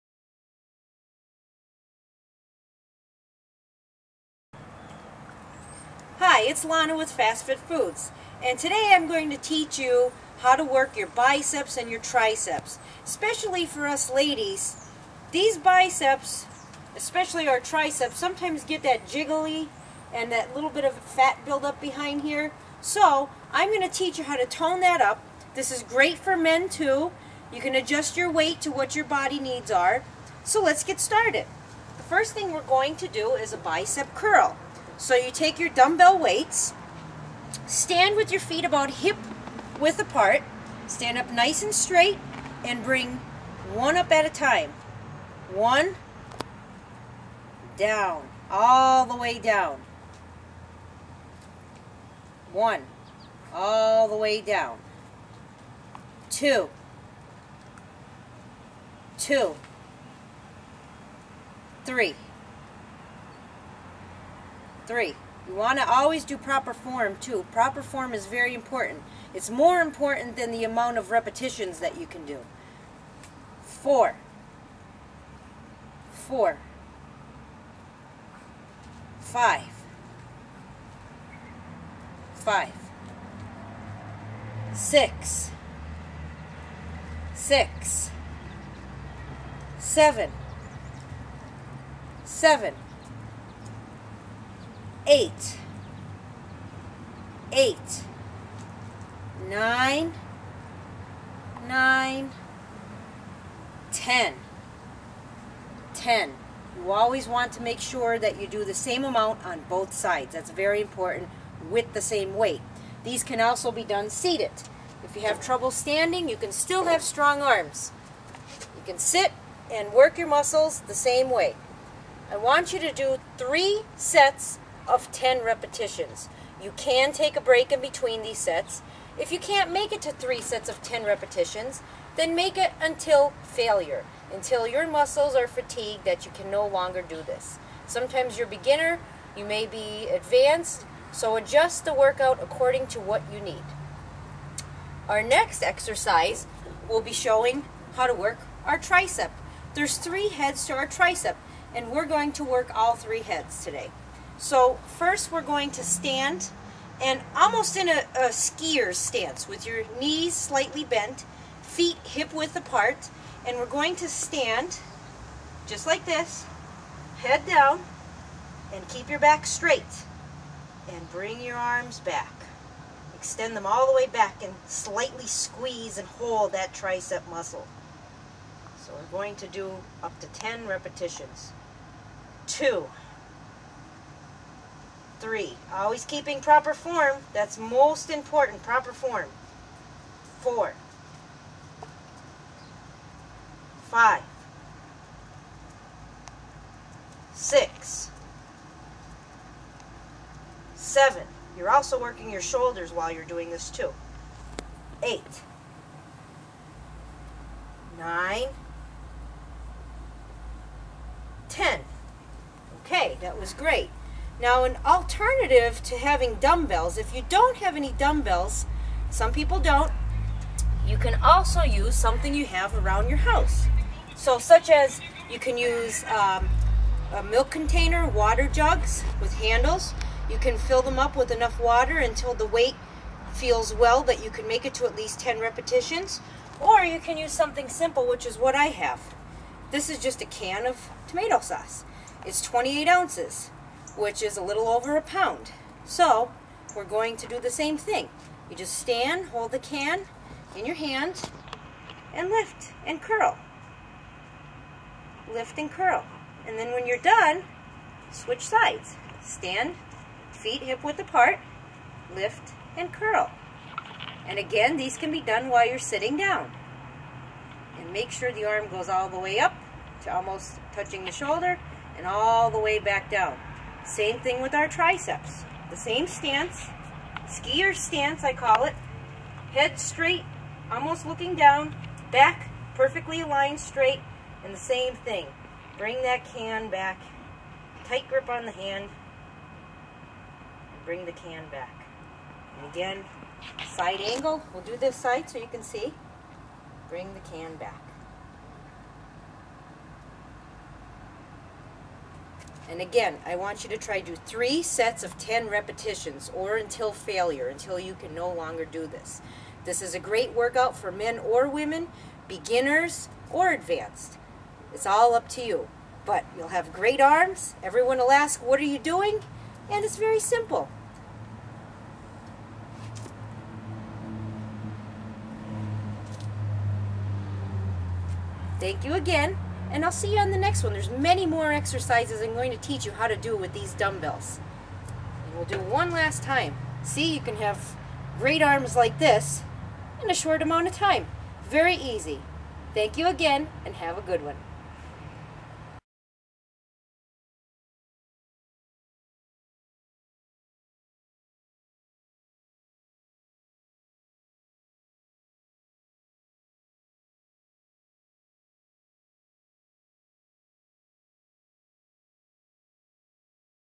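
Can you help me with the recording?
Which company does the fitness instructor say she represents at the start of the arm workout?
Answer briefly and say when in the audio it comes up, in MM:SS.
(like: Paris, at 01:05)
Fast Fit Foods, at 00:07.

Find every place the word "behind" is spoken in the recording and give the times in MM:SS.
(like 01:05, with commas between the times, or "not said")
00:21.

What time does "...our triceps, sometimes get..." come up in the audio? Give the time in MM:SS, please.
00:17.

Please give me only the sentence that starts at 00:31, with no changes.
The first thing we're going to do is a bicep curl.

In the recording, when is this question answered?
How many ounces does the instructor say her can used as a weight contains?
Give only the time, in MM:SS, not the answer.
04:02.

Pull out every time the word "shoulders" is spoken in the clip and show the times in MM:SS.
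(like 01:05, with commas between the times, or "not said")
03:22, 04:31.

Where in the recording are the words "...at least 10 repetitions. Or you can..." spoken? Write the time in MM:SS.
03:54.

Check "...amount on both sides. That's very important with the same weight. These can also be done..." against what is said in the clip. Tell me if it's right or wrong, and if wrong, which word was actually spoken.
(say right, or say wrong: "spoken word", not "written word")
right.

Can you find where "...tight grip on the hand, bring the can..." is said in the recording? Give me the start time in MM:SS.
04:47.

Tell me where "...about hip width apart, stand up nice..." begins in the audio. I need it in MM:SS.
00:38.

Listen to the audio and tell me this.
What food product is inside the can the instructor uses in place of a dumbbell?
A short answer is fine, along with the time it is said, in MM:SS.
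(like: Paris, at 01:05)
tomato sauce, at 04:01.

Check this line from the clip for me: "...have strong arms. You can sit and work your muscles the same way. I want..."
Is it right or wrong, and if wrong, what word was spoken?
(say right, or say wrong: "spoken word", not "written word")
right.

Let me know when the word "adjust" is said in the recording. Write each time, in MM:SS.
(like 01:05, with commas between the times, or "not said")
00:27, 02:21.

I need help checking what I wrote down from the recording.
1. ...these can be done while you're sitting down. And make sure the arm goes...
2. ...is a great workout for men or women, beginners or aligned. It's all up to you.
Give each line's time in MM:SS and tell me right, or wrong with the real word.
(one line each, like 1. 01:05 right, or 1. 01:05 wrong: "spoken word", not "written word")
1. 04:24 right
2. 05:09 wrong: "advanced", not "aligned".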